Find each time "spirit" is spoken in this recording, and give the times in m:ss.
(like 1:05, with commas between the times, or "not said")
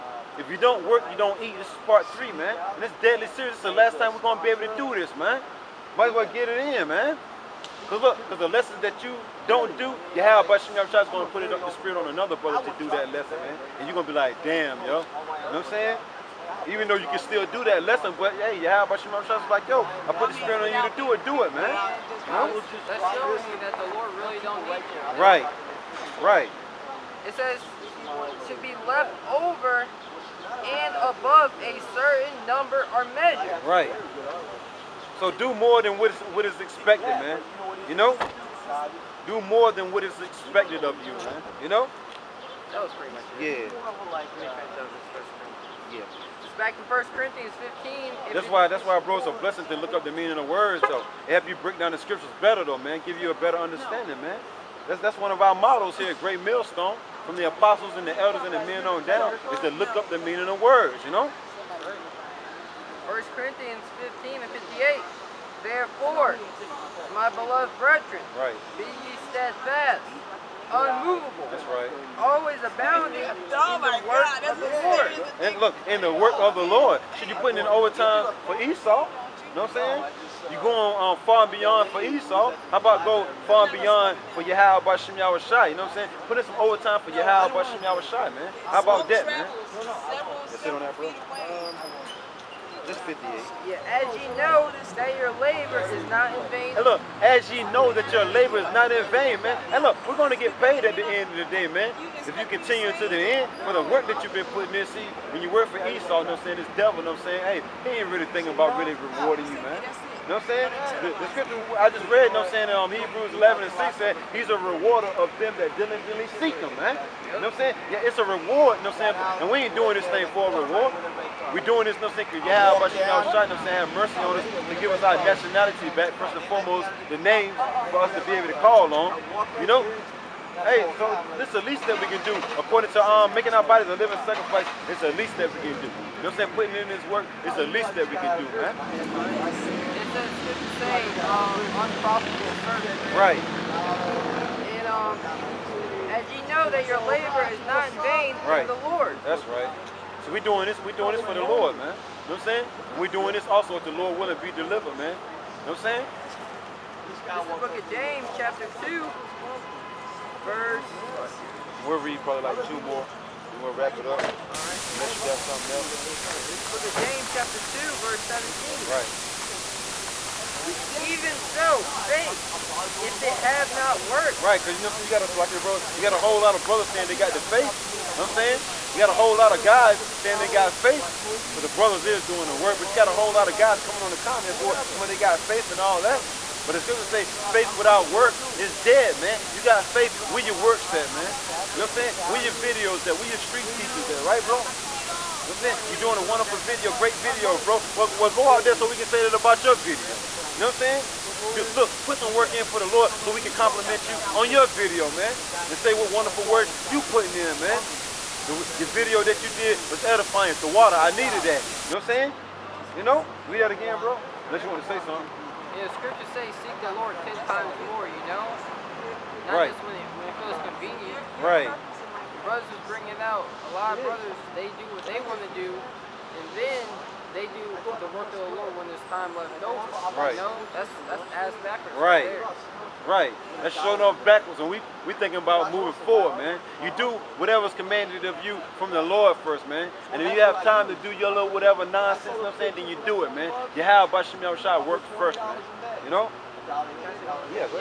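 0:11, 0:20.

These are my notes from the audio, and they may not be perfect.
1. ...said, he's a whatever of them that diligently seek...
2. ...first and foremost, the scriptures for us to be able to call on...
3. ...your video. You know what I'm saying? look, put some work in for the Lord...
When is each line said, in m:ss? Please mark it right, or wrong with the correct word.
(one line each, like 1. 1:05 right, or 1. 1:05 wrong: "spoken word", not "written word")
1. 1:53 wrong: "rewarder", not "whatever"
2. 2:06 wrong: "names", not "scriptures"
3. 3:19 right.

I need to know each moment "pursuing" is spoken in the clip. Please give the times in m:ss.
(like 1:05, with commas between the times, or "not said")
not said.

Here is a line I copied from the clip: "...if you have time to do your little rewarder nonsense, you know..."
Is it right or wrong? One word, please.
wrong.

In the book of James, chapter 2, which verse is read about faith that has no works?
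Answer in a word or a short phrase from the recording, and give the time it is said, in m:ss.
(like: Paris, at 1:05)
17, at 2:48.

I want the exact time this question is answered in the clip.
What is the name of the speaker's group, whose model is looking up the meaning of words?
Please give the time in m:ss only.
0:56.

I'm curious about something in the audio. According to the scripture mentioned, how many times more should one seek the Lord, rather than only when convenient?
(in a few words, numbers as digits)
ten times more.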